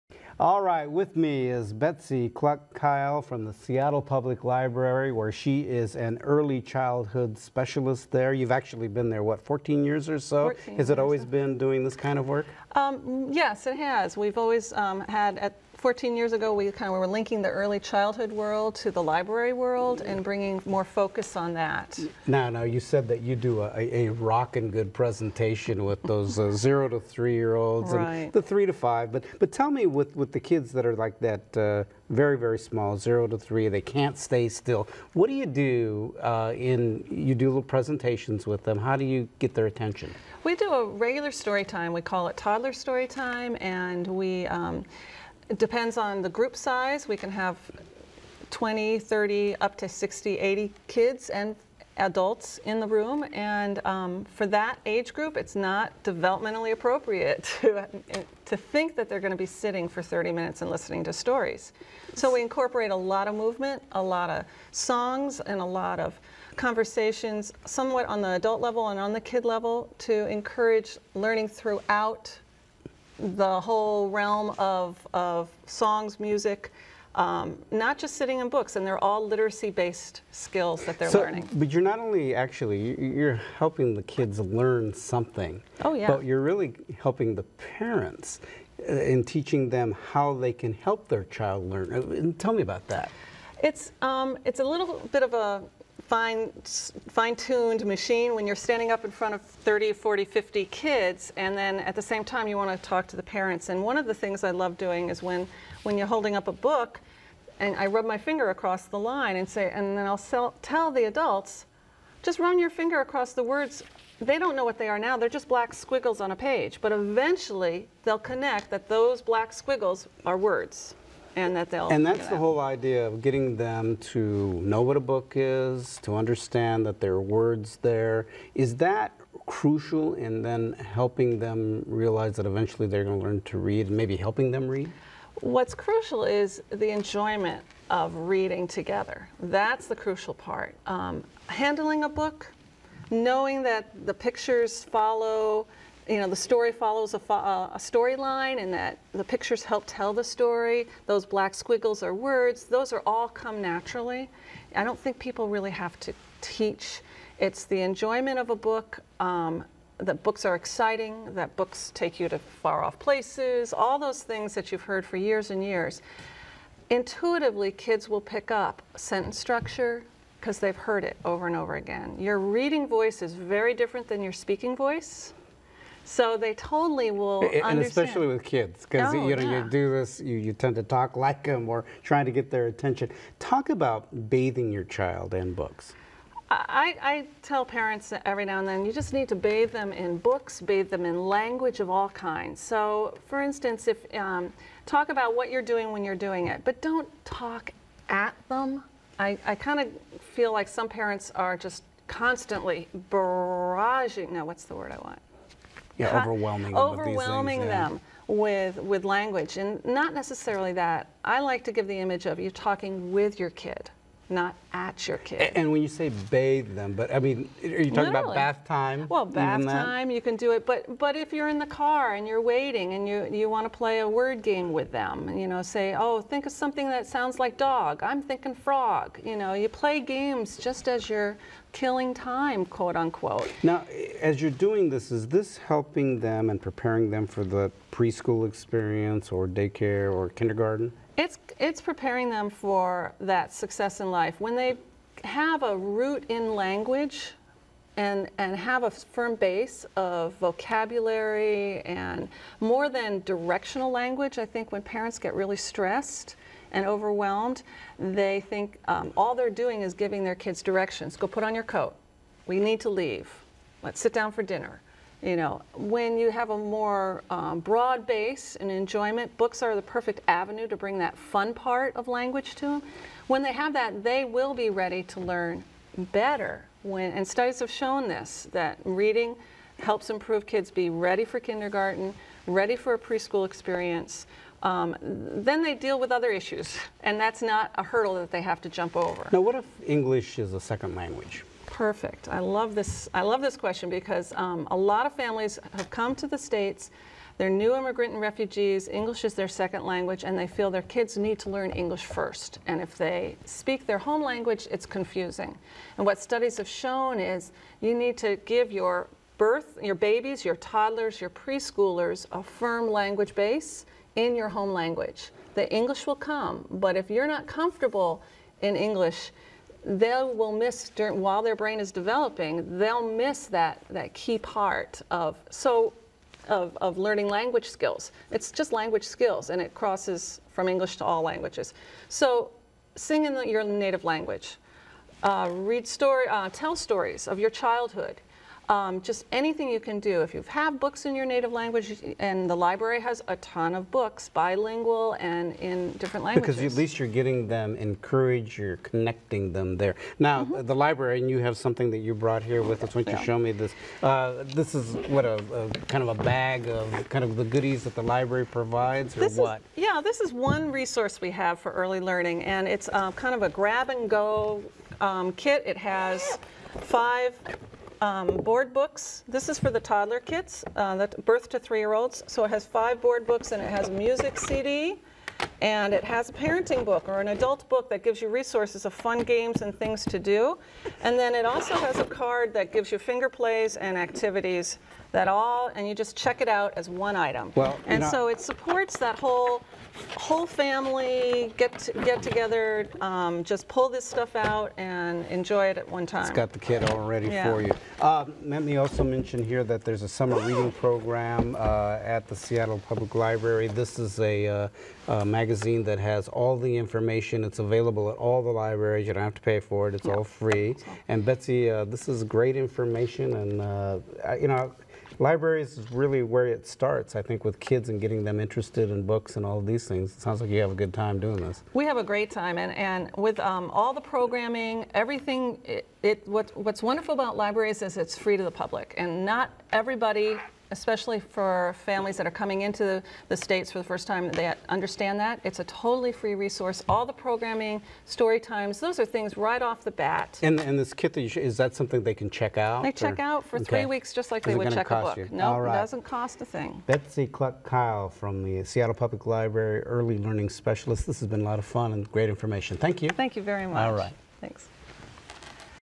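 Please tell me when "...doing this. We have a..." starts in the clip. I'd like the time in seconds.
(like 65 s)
421 s.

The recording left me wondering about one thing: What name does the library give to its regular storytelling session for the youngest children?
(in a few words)
toddler story time.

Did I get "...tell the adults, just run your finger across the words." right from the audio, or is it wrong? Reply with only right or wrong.
right.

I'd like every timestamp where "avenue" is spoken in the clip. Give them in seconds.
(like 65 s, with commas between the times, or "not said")
270 s.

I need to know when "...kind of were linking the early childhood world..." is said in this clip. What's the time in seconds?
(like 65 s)
16 s.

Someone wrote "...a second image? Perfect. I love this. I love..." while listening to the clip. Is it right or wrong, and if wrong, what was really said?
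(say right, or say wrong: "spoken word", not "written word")
wrong: "language", not "image".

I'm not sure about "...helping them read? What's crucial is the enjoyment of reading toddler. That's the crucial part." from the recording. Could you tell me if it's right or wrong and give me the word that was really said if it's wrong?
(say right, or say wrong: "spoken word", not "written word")
wrong: "together", not "toddler".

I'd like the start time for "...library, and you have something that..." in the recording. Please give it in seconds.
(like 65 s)
350 s.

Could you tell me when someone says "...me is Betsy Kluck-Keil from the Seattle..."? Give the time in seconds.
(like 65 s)
1 s.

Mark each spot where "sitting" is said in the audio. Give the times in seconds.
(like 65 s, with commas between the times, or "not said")
59 s, 78 s.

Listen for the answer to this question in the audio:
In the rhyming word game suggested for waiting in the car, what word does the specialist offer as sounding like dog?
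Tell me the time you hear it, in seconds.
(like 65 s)
228 s.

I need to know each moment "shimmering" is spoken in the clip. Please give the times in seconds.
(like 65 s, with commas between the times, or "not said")
not said.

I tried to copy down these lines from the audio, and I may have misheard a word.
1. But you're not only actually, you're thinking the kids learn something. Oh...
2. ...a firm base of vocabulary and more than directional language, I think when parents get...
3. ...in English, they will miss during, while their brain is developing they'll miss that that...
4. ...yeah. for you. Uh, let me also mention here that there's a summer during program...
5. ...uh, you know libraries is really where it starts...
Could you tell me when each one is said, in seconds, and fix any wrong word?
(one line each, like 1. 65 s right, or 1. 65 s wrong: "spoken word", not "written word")
1. 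81 s wrong: "helping", not "thinking"
2. 248 s right
3. 318 s right
4. 397 s wrong: "reading", not "during"
5. 413 s right.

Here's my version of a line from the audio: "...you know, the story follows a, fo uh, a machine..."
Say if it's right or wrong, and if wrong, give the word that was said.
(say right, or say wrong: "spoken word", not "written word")
wrong: "storyline", not "machine".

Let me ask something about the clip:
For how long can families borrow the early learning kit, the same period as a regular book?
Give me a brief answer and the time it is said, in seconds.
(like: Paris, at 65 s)
3 weeks, at 443 s.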